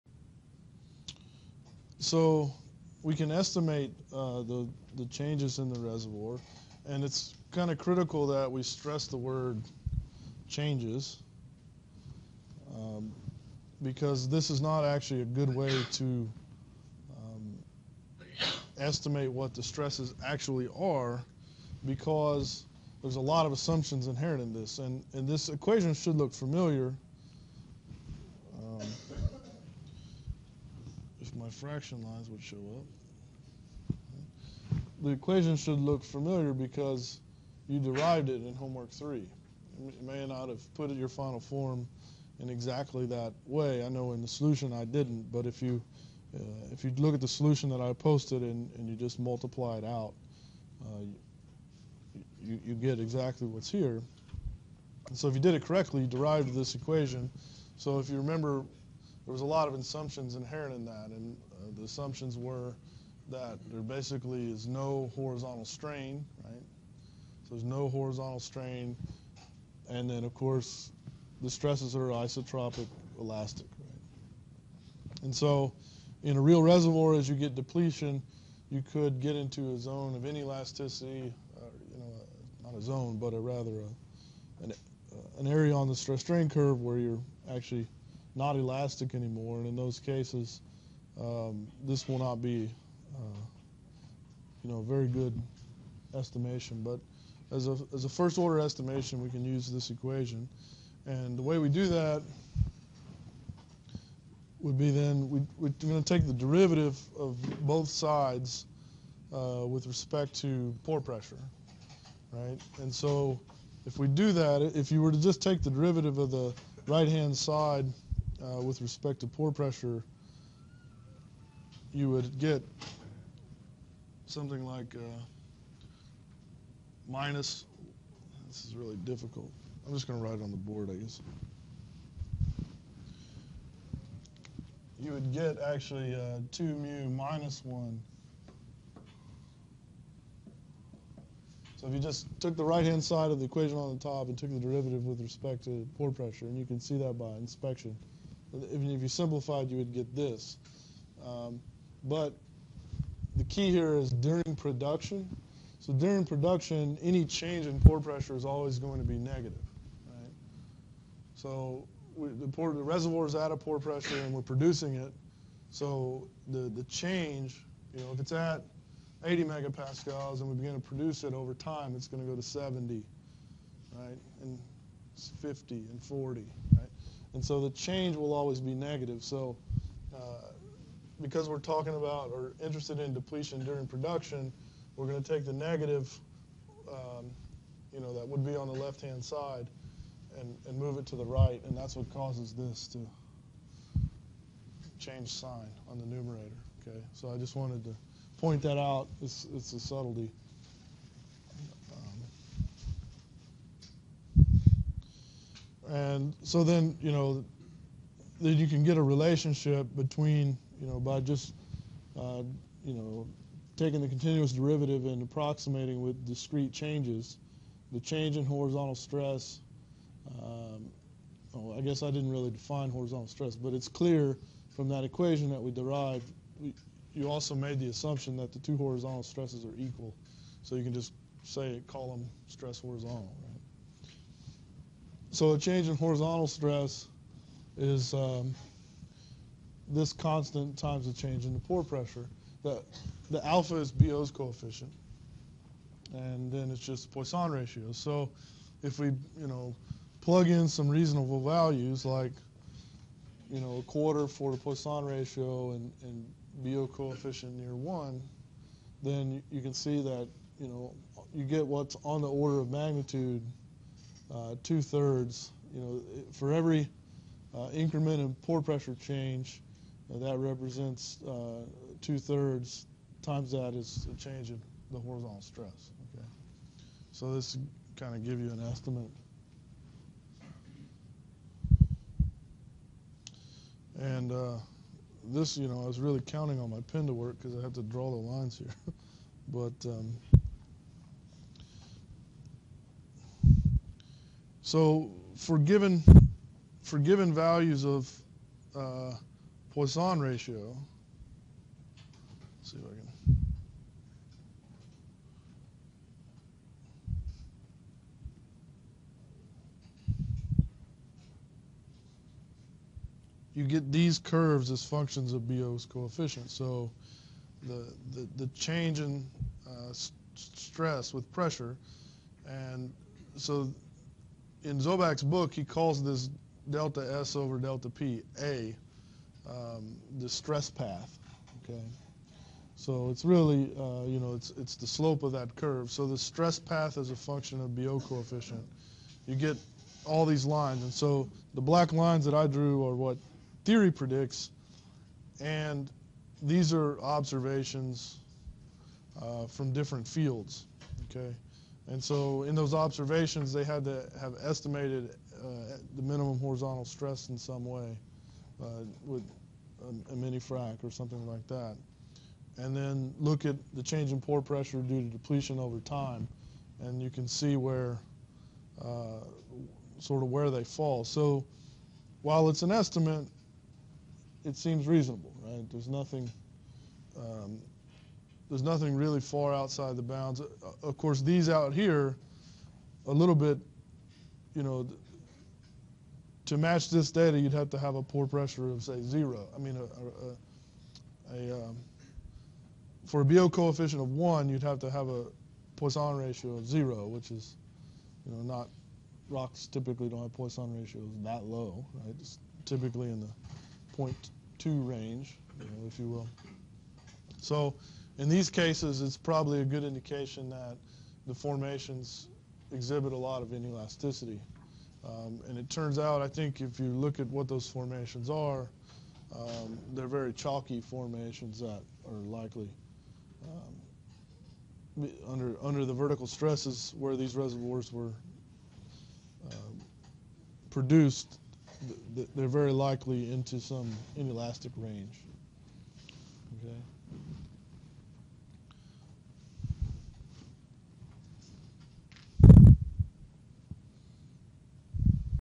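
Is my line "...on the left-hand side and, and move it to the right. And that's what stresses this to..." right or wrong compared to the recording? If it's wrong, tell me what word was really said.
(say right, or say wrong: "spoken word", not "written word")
wrong: "causes", not "stresses".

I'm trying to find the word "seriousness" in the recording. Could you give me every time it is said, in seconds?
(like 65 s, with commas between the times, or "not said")
not said.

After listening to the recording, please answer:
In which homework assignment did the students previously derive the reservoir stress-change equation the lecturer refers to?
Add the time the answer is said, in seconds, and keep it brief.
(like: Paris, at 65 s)
Homework 3, at 38 s.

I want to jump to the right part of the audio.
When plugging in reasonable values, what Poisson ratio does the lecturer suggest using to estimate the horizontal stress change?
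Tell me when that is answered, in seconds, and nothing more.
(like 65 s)
253 s.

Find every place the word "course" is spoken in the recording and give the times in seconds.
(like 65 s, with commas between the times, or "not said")
70 s, 380 s.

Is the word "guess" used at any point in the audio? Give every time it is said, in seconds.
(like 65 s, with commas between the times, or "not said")
130 s, 221 s.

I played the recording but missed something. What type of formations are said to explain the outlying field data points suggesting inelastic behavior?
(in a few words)
Chalky formations.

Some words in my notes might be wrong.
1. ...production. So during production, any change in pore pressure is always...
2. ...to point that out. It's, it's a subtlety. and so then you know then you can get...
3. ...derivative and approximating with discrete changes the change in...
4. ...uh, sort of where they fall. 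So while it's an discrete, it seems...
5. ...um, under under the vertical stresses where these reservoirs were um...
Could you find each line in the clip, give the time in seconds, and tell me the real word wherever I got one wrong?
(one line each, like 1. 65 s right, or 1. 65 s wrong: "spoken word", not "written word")
1. 154 s right
2. 197 s right
3. 214 s right
4. 368 s wrong: "estimate", not "discrete"
5. 424 s right.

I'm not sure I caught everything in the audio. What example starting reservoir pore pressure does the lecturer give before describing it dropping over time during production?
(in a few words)
80 megapascals.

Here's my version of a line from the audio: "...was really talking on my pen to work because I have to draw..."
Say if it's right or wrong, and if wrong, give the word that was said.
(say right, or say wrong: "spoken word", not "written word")
wrong: "counting", not "talking".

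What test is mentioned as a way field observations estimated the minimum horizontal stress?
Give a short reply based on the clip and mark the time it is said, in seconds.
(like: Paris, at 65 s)
Mini frac, at 360 s.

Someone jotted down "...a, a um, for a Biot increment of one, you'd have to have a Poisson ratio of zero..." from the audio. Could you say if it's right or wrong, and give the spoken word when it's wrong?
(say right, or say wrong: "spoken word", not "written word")
wrong: "coefficient", not "increment".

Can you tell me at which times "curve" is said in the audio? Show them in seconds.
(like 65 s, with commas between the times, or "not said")
86 s, 314 s, 335 s.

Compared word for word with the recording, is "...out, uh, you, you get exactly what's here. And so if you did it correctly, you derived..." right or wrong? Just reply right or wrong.
right.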